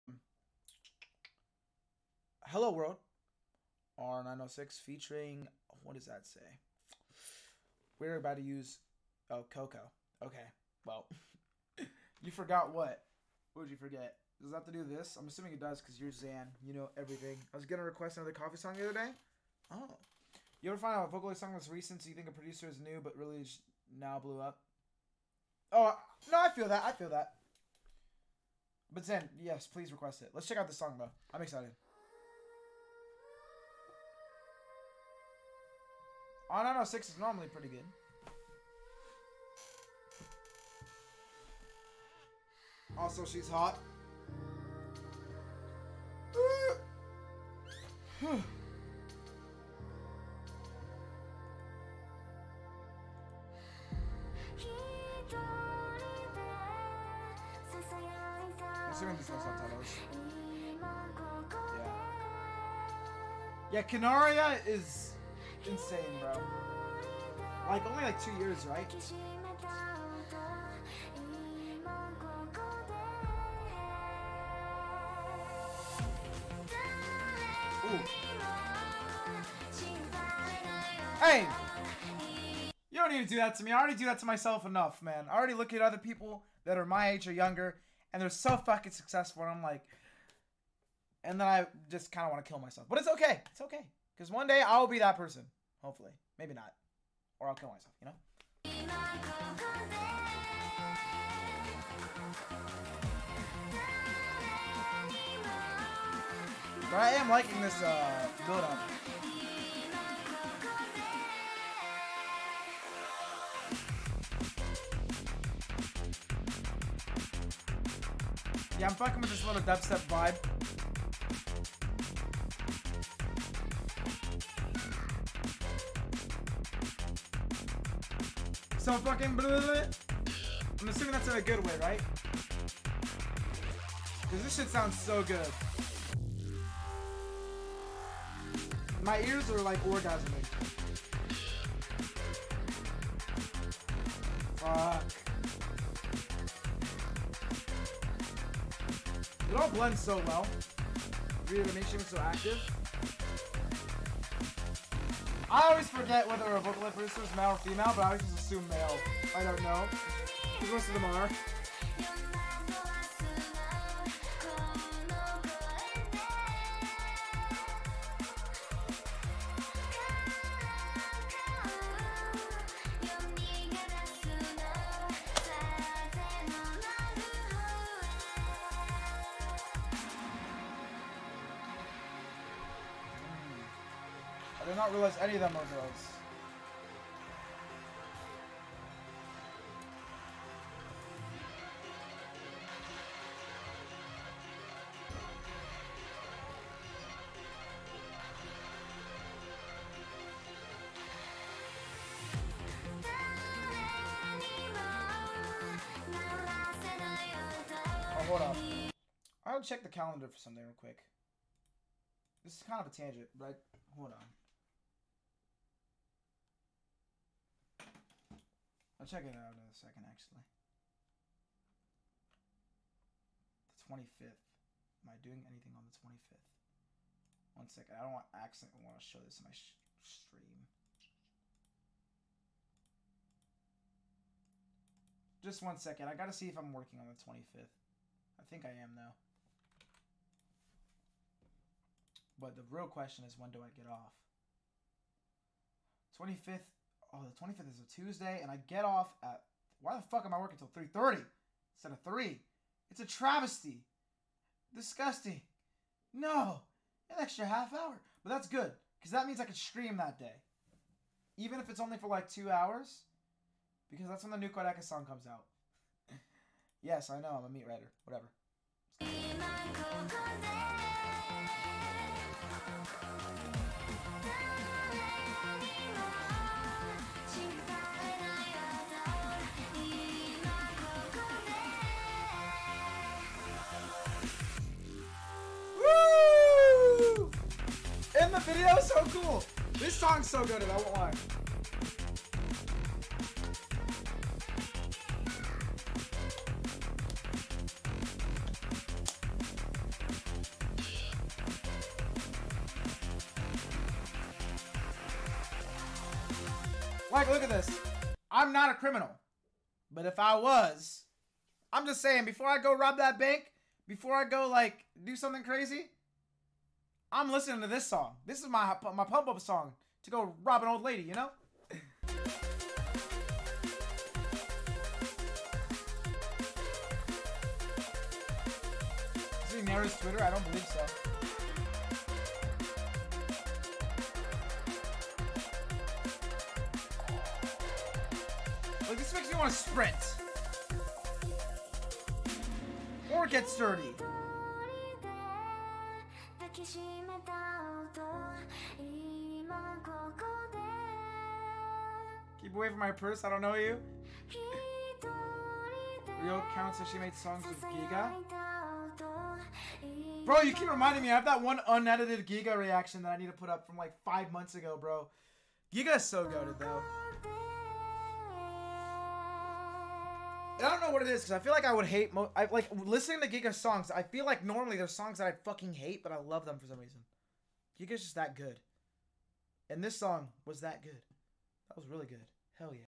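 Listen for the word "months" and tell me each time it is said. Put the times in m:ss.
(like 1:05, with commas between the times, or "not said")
6:04.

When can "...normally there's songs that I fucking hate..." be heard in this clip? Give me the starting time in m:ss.
6:14.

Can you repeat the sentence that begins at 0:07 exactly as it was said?
We're about to use, oh, Coco.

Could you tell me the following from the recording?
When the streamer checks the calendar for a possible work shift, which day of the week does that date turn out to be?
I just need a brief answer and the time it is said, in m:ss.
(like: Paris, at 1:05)
Tuesday, at 4:08.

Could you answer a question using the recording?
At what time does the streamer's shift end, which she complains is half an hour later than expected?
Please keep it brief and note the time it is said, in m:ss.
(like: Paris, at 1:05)
3:30, at 4:10.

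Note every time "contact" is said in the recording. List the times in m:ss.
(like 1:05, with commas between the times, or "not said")
not said.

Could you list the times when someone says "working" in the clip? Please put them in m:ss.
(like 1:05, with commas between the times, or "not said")
3:56, 4:10.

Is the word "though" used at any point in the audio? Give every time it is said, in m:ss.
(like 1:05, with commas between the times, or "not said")
0:30, 3:58, 6:06.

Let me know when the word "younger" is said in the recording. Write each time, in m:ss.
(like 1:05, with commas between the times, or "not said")
1:27.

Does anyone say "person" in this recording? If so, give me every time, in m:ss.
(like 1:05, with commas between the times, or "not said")
1:35.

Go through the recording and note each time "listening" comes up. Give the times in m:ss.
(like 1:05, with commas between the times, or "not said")
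5:17, 6:12.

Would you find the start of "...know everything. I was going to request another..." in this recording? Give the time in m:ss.
0:16.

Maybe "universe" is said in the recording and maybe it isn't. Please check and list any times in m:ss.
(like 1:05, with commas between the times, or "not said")
not said.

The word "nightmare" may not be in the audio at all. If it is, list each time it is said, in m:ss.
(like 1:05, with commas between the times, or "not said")
not said.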